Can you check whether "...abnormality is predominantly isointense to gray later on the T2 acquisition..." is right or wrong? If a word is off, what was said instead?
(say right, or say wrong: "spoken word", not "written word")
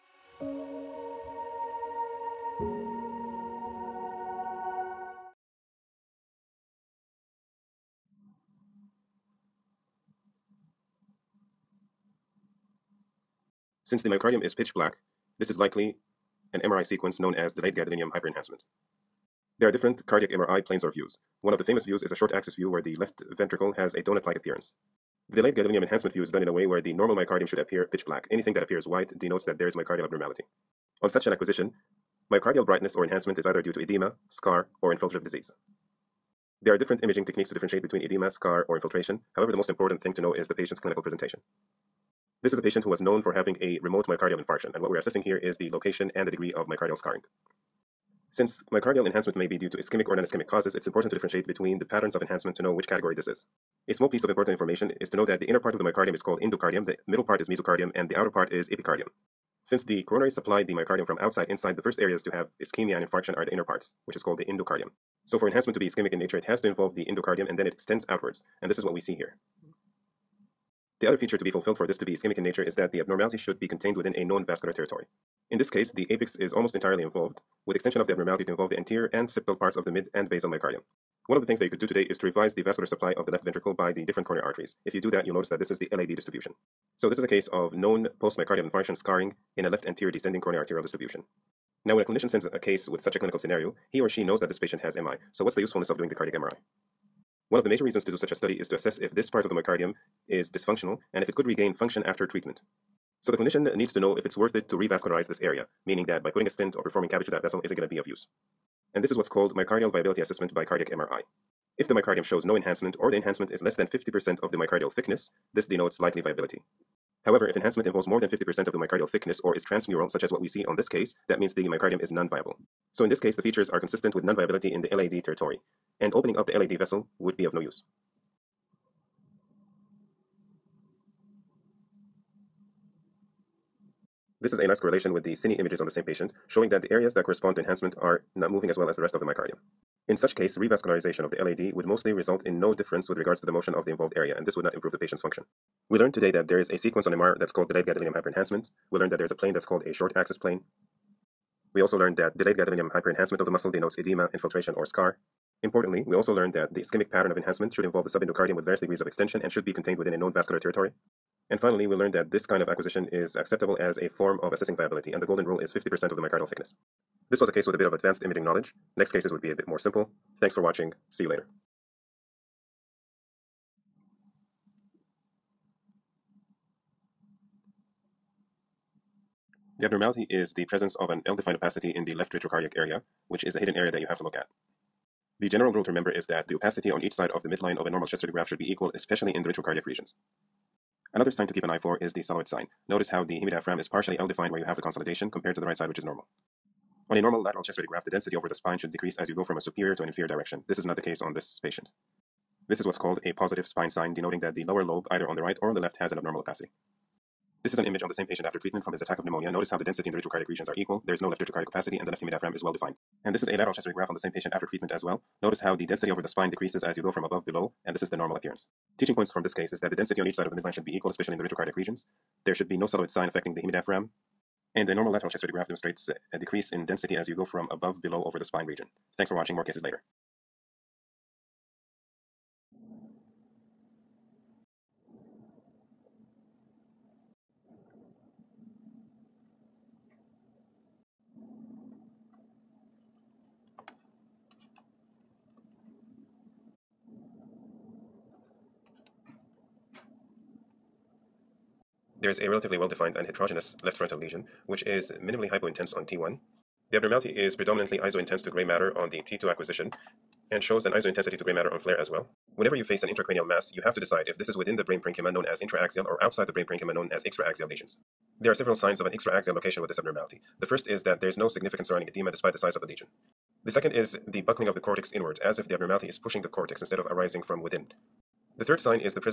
wrong: "matter", not "later".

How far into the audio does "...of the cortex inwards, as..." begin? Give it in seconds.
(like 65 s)
274 s.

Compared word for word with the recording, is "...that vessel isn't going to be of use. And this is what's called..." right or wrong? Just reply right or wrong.
right.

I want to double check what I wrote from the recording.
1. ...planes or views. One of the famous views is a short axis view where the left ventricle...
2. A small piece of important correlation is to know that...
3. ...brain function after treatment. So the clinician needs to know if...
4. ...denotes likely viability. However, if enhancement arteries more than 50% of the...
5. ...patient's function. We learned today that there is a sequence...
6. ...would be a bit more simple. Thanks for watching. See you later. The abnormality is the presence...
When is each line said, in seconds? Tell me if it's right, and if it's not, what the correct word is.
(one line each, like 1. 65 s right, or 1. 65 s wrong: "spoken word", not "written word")
1. 20 s right
2. 53 s wrong: "information", not "correlation"
3. 101 s wrong: "regain", not "brain"
4. 115 s wrong: "involves", not "arteries"
5. 144 s right
6. 169 s right.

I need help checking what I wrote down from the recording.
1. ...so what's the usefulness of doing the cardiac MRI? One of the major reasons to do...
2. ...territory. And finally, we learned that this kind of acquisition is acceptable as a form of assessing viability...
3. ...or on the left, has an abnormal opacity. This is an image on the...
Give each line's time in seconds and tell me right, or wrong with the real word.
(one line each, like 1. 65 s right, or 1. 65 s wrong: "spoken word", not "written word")
1. 95 s right
2. 160 s right
3. 205 s right.